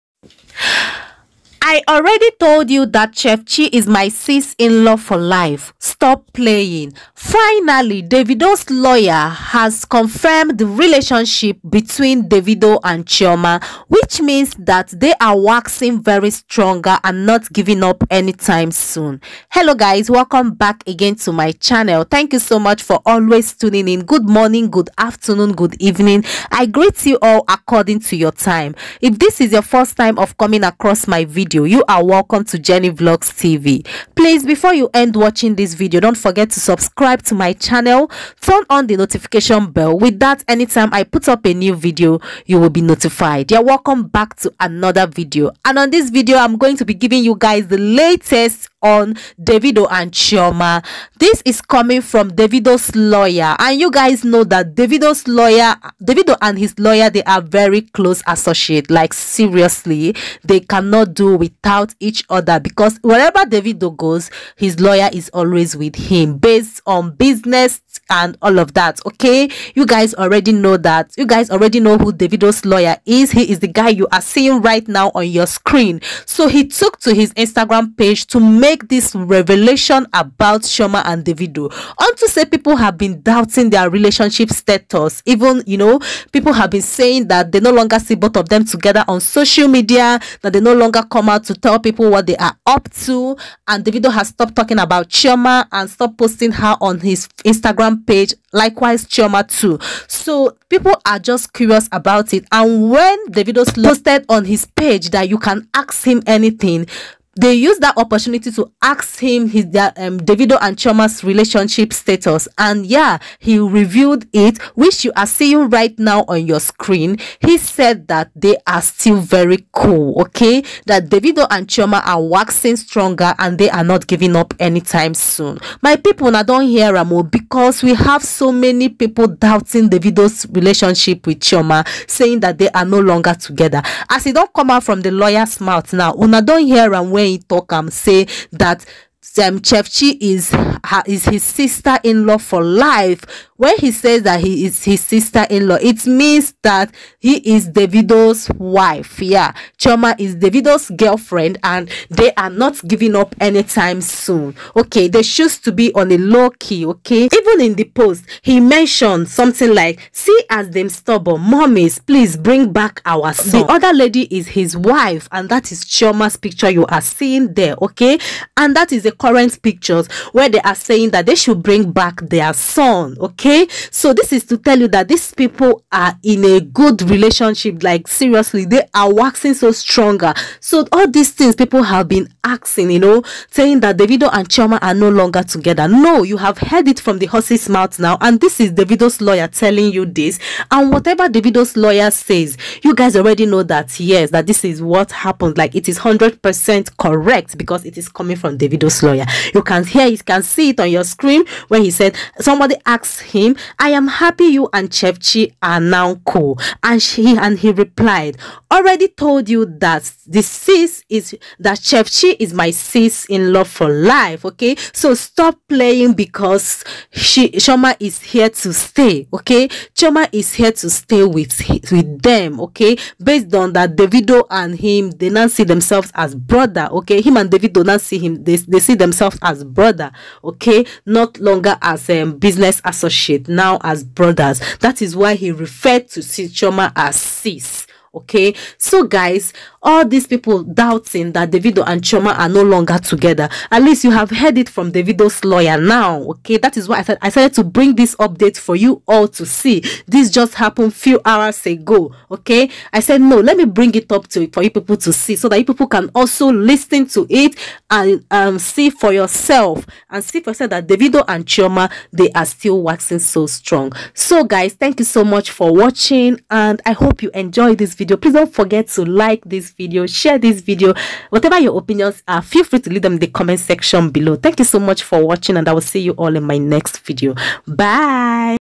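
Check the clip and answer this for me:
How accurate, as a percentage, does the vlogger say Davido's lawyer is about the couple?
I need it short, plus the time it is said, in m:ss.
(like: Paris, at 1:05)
100 percent, at 3:15.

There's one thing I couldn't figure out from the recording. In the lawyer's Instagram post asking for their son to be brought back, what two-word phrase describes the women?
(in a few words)
stubborn mummies.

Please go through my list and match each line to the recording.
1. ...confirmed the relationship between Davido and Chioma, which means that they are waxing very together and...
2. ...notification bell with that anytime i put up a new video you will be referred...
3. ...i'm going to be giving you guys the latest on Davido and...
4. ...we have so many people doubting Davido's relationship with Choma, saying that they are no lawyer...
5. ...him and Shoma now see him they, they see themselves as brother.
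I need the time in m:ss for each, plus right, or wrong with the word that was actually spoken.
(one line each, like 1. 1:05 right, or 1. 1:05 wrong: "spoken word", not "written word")
1. 0:09 wrong: "stronger", not "together"
2. 0:38 wrong: "notified", not "referred"
3. 0:46 right
4. 2:07 wrong: "longer", not "lawyer"
5. 3:47 wrong: "Davido", not "Shoma".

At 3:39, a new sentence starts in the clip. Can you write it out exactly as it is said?
Okay, Choma is here to stay with with them.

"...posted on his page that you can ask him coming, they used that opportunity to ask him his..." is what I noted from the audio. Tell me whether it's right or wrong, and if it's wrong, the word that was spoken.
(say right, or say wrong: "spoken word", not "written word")
wrong: "anything", not "coming".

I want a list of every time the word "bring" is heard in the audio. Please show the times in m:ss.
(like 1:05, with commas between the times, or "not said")
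2:42, 2:51, 4:07, 4:13.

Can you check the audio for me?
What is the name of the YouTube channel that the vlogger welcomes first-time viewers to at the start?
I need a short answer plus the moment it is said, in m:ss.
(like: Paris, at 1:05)
Jenny Vlogs TV, at 0:32.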